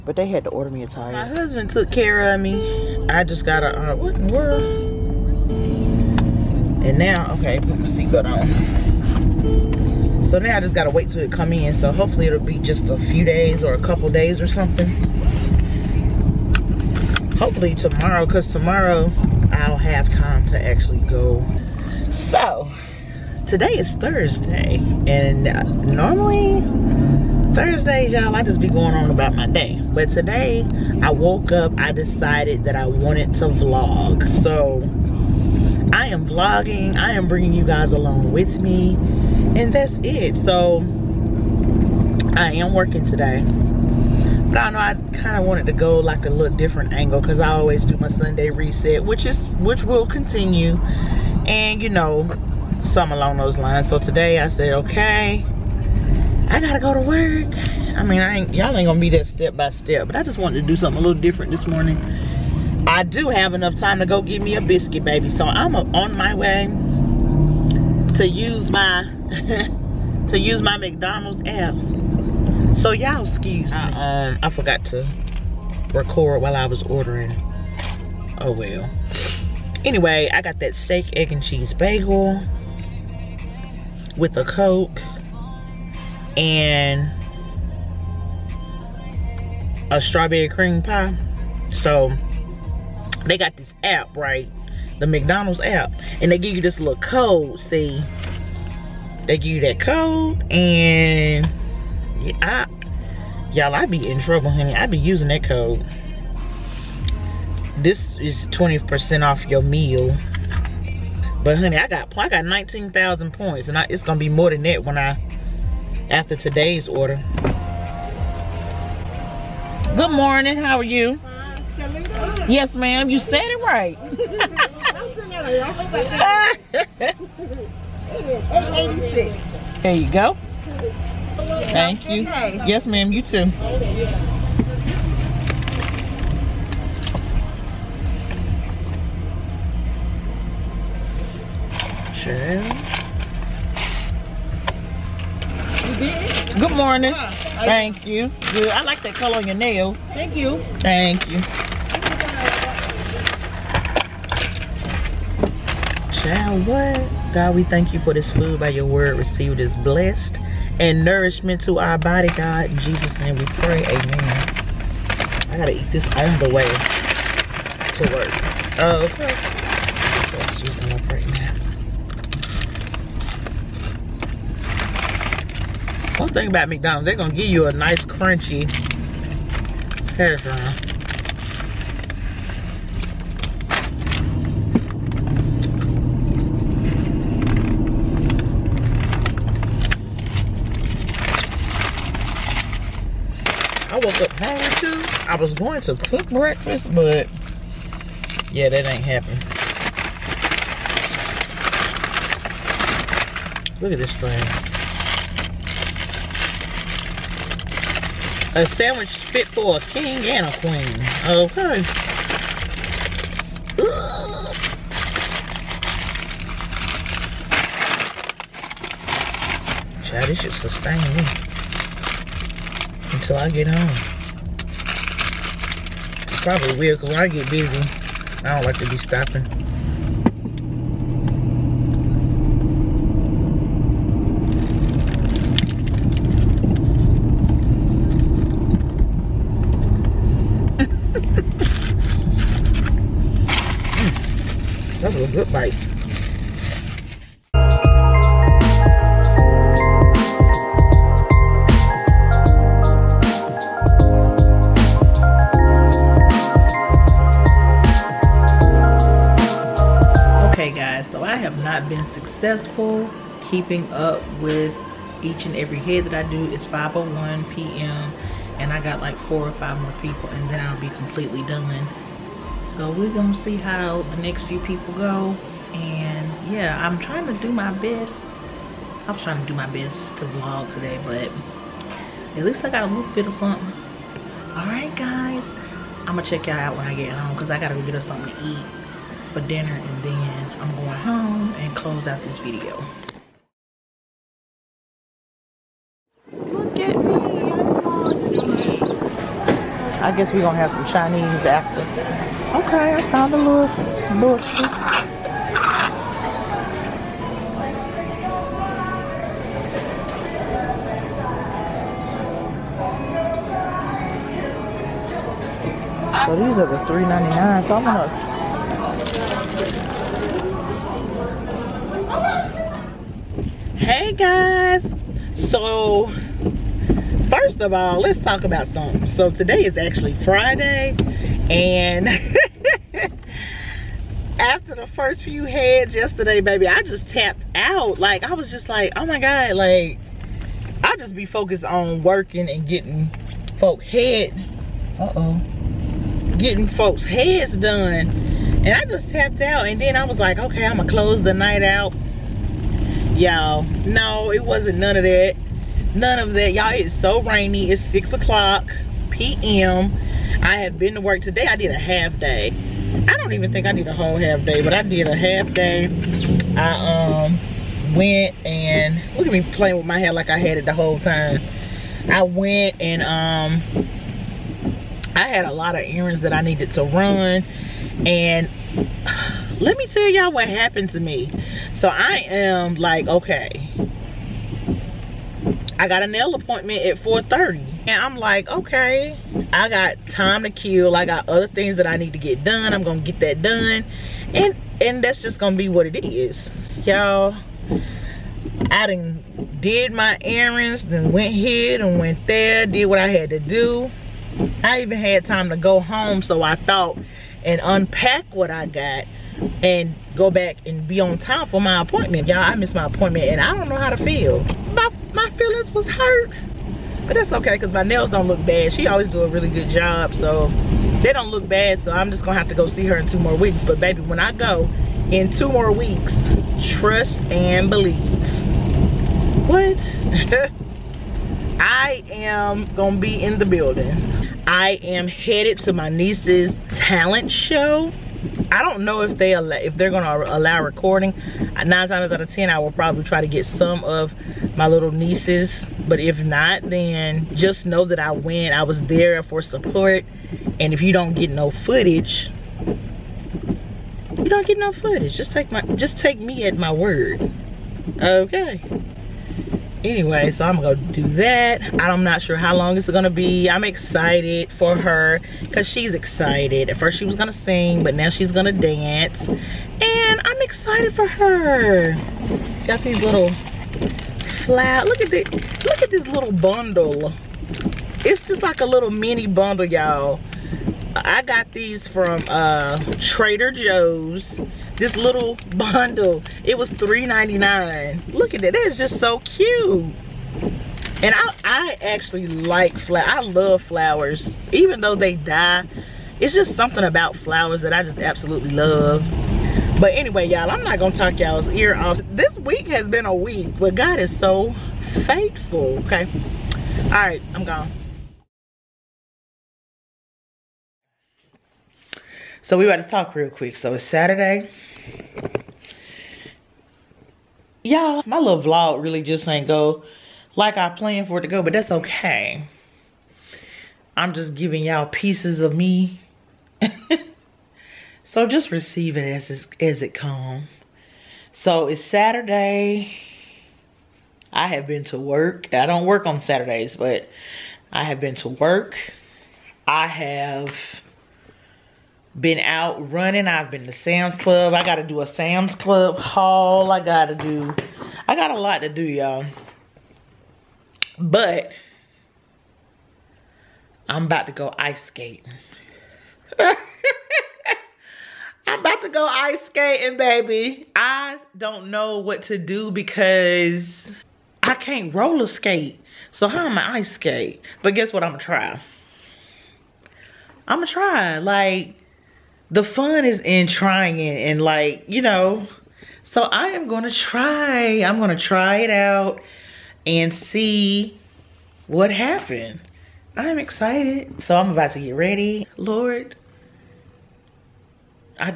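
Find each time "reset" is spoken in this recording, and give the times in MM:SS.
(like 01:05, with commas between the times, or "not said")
00:48.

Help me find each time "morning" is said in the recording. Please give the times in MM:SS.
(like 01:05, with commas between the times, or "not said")
01:01, 02:00, 02:26.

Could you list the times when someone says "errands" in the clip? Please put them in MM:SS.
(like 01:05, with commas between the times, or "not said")
06:15, 06:40.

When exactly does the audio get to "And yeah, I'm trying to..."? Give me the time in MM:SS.
04:35.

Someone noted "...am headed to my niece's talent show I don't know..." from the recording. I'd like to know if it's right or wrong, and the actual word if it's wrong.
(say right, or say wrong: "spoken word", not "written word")
right.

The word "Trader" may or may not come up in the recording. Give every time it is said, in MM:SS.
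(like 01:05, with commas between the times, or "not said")
08:02.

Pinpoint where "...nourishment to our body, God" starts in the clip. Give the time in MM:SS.
02:41.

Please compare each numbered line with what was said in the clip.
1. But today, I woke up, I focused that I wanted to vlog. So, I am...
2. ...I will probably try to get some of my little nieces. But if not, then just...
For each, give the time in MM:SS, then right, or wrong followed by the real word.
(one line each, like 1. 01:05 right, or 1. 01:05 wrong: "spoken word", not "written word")
1. 00:29 wrong: "decided", not "focused"
2. 07:22 right.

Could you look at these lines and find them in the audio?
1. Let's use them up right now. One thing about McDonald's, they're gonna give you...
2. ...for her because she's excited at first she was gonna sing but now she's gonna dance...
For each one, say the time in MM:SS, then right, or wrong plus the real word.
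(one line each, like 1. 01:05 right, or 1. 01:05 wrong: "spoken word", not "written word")
1. 02:50 right
2. 07:44 right.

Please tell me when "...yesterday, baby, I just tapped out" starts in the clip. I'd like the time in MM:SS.
05:35.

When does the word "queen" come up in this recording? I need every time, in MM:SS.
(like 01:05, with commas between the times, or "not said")
03:30.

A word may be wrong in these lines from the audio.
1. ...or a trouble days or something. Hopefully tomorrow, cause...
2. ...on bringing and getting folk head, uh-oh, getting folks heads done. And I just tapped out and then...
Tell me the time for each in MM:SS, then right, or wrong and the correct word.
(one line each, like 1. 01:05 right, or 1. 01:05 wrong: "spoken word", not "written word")
1. 00:13 wrong: "couple", not "trouble"
2. 05:41 wrong: "working", not "bringing".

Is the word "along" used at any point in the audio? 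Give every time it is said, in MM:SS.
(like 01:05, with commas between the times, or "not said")
00:37, 00:53.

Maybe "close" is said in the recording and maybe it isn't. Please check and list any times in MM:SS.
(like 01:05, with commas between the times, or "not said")
04:51, 05:50.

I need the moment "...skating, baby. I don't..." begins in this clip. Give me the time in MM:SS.
09:19.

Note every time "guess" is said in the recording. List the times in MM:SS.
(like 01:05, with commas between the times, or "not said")
05:00, 09:27.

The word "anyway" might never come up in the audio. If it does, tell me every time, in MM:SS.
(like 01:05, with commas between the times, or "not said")
01:19, 07:39, 08:19.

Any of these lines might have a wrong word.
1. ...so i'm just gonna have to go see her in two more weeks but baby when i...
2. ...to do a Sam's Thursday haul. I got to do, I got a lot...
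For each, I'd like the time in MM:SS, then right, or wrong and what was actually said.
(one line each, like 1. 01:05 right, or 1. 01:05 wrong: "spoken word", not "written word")
1. 07:01 right
2. 09:04 wrong: "Club", not "Thursday".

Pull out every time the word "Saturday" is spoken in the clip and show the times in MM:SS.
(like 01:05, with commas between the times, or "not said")
08:33, 08:51, 08:56.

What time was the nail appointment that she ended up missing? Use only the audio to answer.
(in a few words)
4:30.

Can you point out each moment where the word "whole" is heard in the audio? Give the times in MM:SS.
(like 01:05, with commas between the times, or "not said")
06:03, 06:10.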